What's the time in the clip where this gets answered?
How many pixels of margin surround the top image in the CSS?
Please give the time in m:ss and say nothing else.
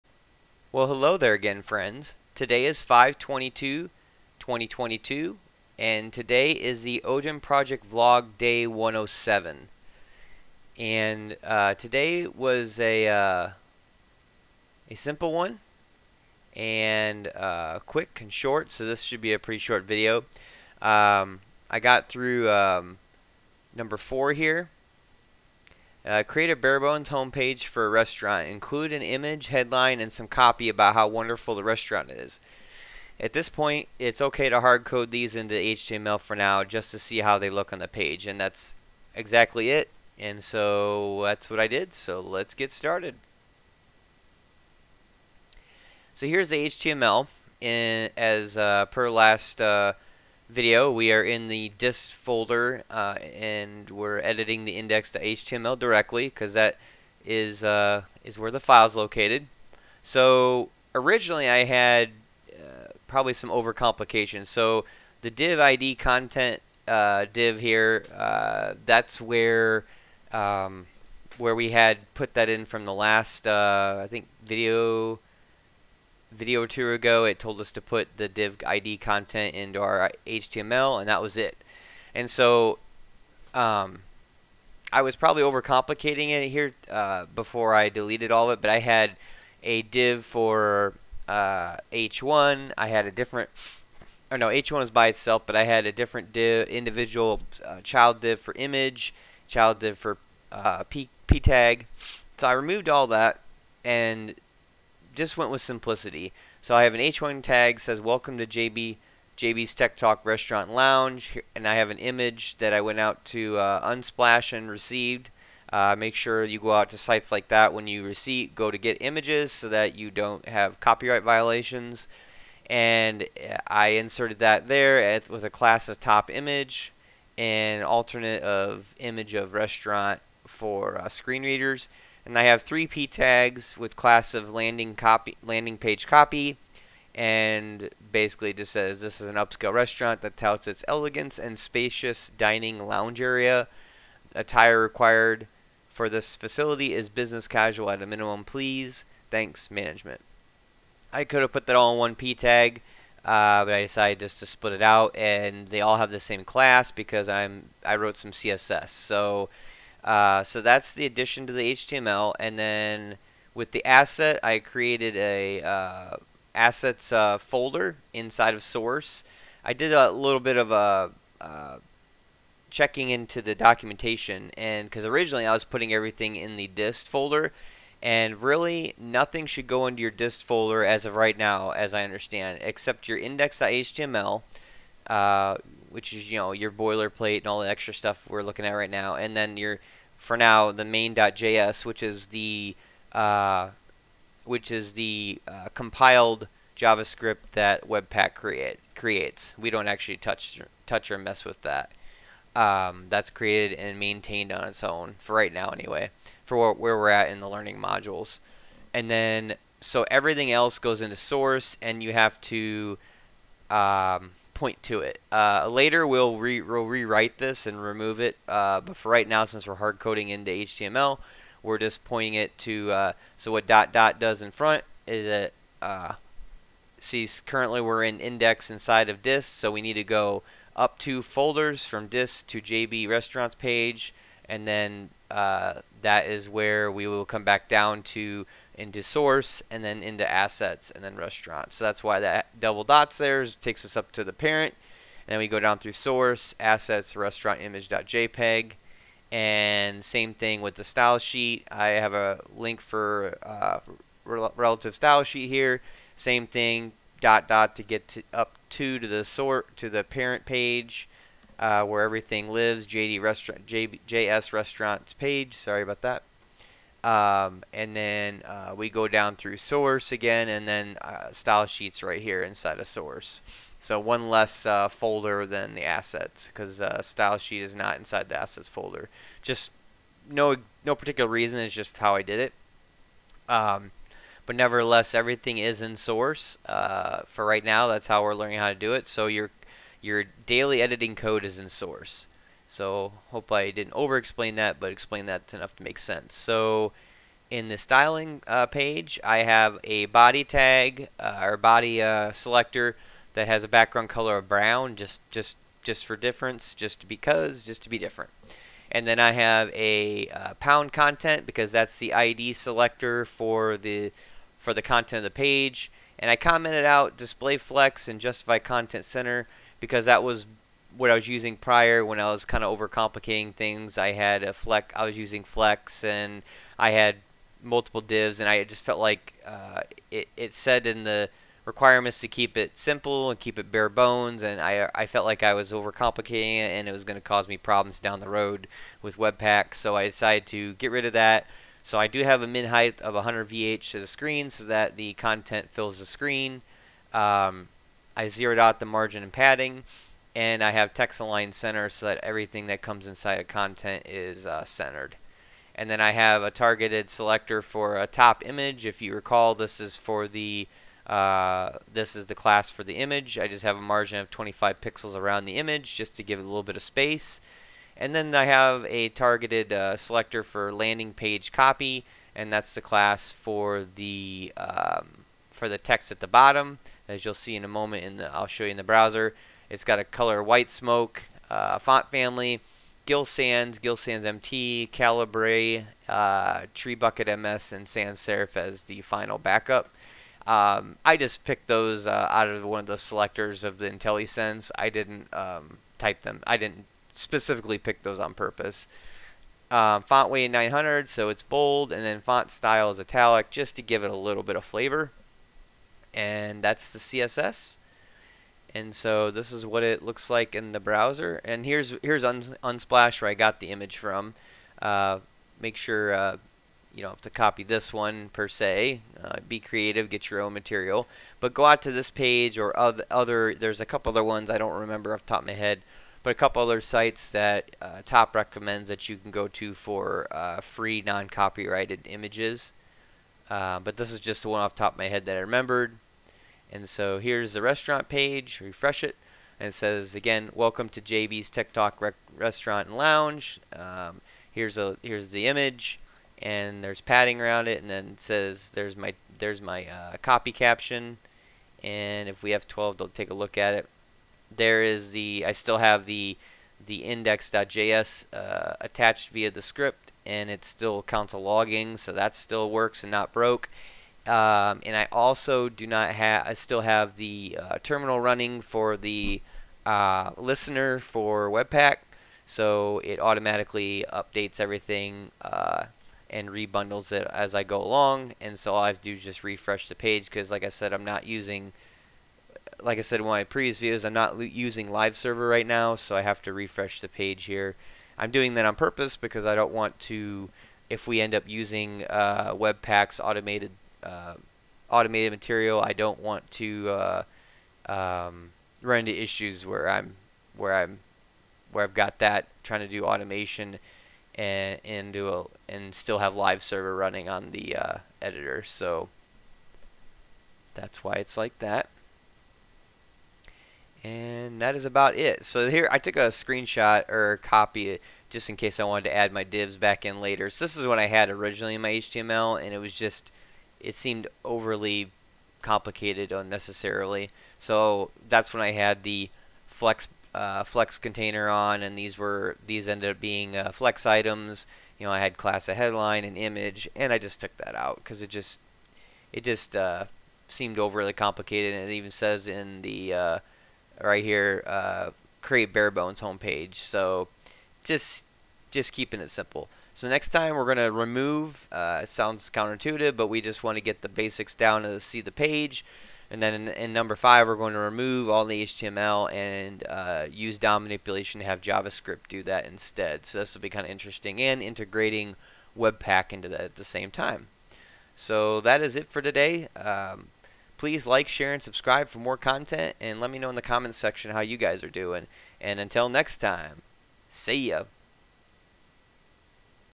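6:04.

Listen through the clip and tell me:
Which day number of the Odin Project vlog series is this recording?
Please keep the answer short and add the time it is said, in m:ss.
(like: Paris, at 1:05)
107, at 0:08.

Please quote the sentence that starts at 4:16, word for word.
Same thing, dot dot to get to, up to to the sort to the parent page.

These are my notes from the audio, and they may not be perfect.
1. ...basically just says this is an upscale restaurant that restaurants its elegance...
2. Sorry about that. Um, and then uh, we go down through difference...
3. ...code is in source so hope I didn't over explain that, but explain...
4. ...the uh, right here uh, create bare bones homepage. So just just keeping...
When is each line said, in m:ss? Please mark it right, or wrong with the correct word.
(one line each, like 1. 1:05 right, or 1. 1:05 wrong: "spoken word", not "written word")
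1. 2:18 wrong: "touts", not "restaurants"
2. 4:25 wrong: "source", not "difference"
3. 4:51 right
4. 9:02 right.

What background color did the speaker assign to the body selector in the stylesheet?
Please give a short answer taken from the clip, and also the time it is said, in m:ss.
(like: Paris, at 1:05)
Brown, at 5:04.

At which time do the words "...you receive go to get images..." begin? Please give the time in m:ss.
1:57.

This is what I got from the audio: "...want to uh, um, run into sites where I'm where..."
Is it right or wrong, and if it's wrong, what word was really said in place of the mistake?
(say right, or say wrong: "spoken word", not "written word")
wrong: "issues", not "sites".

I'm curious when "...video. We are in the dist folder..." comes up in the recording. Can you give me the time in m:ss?
0:50.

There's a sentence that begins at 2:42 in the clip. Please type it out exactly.
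And then with the asset, I created a uh, assets uh, folder inside of source.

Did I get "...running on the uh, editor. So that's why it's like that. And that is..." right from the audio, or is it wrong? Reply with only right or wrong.
right.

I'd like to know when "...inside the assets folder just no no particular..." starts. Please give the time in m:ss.
4:37.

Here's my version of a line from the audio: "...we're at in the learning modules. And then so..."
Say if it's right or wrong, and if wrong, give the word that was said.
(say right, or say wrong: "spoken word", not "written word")
right.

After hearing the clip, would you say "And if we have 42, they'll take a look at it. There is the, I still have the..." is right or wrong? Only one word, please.
wrong.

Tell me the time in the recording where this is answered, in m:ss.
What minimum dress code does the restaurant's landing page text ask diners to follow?
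2:27.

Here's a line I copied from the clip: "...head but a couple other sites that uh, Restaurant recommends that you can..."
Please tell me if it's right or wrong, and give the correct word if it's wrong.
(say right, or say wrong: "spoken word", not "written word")
wrong: "TOP", not "Restaurant".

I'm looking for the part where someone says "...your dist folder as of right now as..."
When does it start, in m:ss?
3:00.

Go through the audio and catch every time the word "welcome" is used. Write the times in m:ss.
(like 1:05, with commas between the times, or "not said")
1:47, 7:20.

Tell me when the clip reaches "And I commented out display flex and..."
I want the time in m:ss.
5:16.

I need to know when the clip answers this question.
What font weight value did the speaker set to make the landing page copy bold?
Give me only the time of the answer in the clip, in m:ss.
6:40.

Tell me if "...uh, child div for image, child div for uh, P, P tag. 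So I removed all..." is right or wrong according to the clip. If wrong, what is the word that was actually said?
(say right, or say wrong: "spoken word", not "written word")
right.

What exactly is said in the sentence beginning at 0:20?
Um, I got through um, number four here, uh, create a barebones homepage for a restaurant.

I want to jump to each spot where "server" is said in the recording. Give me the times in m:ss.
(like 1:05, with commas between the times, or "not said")
8:05, 8:26.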